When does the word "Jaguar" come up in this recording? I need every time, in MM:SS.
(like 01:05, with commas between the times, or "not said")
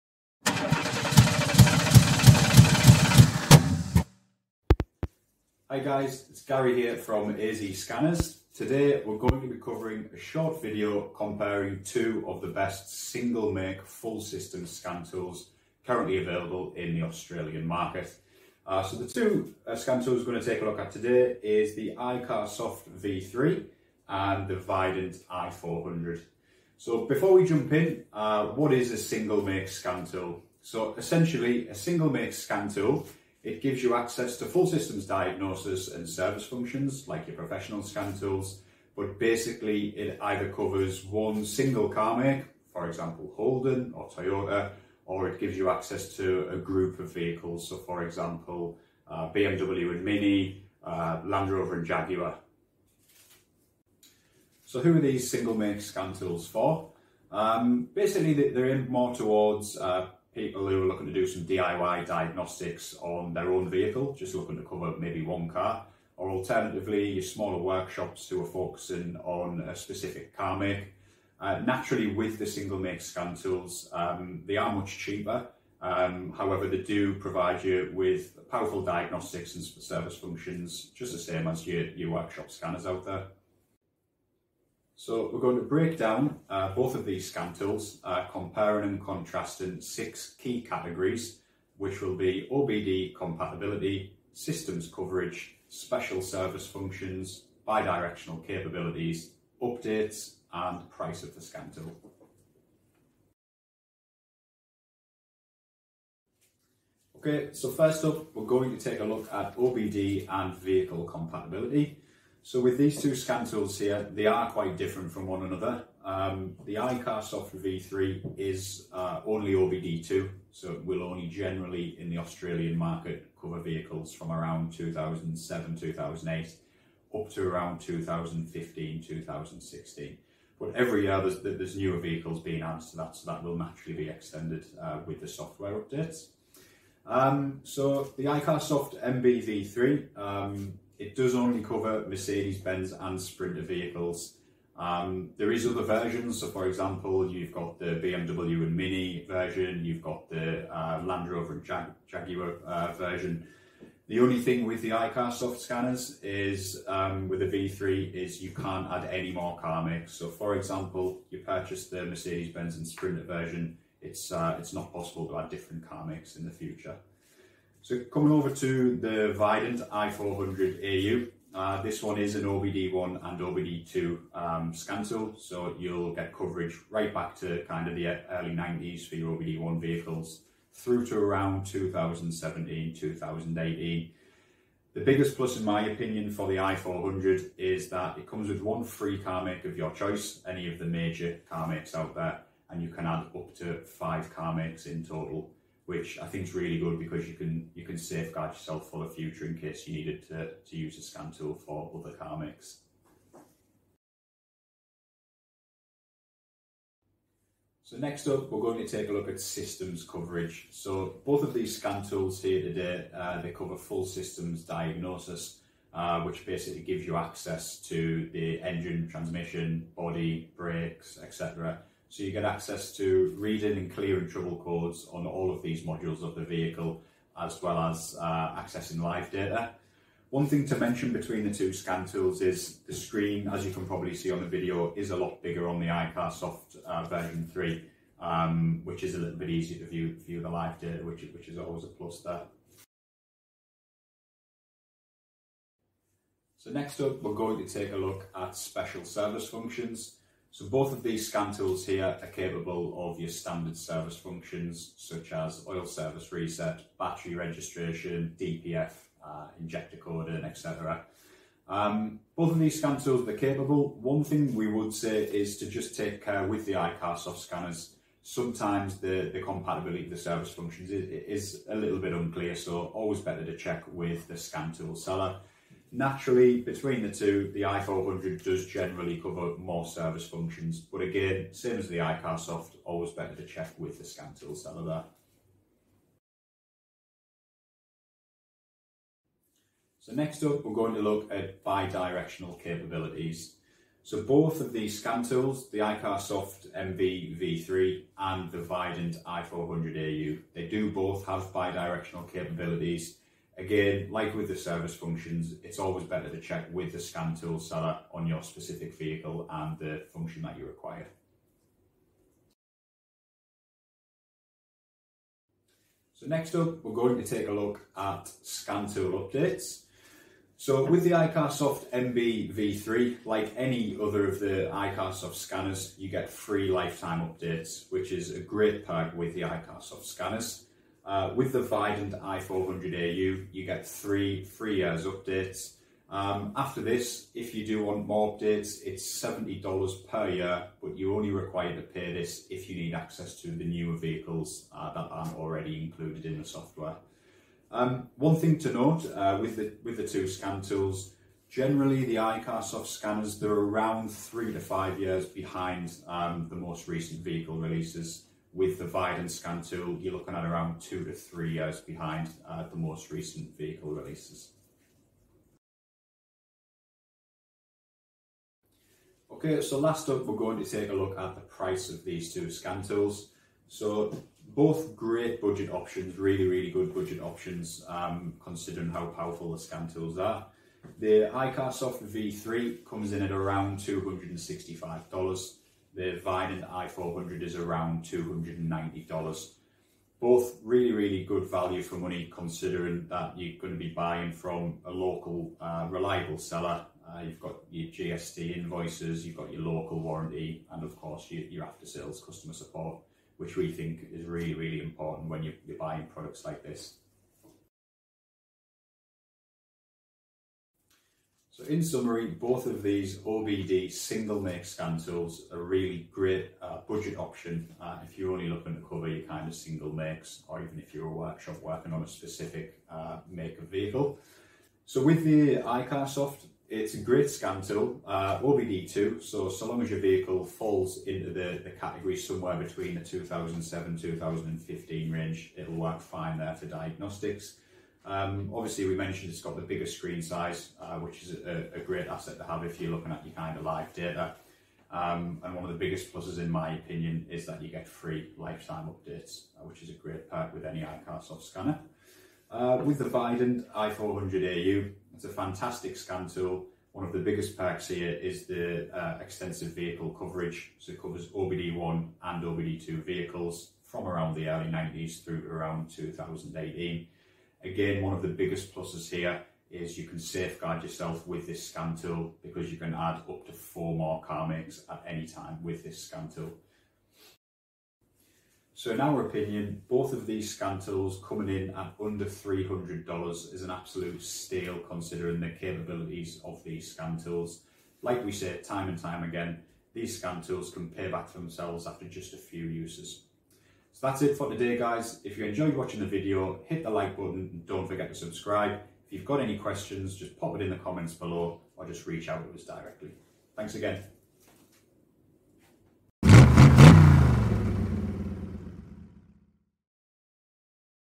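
00:51, 02:32.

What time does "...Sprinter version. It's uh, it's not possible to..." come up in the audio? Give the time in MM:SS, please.
02:42.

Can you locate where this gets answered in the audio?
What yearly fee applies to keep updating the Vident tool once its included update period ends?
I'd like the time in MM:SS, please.
05:39.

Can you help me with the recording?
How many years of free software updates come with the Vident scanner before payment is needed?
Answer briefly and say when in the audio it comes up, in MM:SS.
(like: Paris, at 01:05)
3, at 05:33.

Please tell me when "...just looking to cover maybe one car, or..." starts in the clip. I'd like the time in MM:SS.
01:04.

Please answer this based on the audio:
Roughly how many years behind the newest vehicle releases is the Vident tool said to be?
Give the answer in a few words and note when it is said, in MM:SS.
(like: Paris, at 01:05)
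2 to 3 years, at 06:00.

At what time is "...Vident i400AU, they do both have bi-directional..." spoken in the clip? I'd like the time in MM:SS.
04:58.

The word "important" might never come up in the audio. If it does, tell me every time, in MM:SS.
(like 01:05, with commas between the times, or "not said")
06:44.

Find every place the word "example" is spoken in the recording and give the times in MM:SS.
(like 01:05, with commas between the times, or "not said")
00:42, 00:48, 02:26, 02:40.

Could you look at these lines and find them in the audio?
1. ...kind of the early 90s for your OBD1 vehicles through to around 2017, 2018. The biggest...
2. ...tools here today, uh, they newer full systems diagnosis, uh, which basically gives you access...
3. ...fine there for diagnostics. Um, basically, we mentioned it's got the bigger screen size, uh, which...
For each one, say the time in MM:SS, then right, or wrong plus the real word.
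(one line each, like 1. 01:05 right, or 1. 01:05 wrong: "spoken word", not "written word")
1. 02:57 right
2. 03:32 wrong: "cover", not "newer"
3. 07:16 wrong: "obviously", not "basically".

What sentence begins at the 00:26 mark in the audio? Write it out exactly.
So before we jump in, uh, what is a single make scan tool?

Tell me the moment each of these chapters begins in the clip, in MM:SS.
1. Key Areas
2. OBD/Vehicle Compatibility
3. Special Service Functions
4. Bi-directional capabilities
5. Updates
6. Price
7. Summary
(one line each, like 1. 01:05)
1. 01:23
2. 01:43
3. 04:03
4. 04:46
5. 05:13
6. 06:07
7. 06:48.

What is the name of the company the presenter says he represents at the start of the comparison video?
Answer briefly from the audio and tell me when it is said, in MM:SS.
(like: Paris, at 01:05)
AZ Scanners, at 00:07.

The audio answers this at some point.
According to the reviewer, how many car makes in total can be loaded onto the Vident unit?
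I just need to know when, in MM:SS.
03:13.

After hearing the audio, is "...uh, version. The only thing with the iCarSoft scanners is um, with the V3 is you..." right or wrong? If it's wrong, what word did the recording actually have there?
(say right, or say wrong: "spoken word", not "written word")
right.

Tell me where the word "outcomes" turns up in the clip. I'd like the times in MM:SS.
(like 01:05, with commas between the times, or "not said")
not said.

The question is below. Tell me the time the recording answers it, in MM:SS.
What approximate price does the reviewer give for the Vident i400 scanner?
06:28.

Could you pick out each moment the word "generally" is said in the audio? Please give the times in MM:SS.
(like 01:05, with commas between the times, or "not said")
02:01, 04:38, 05:51.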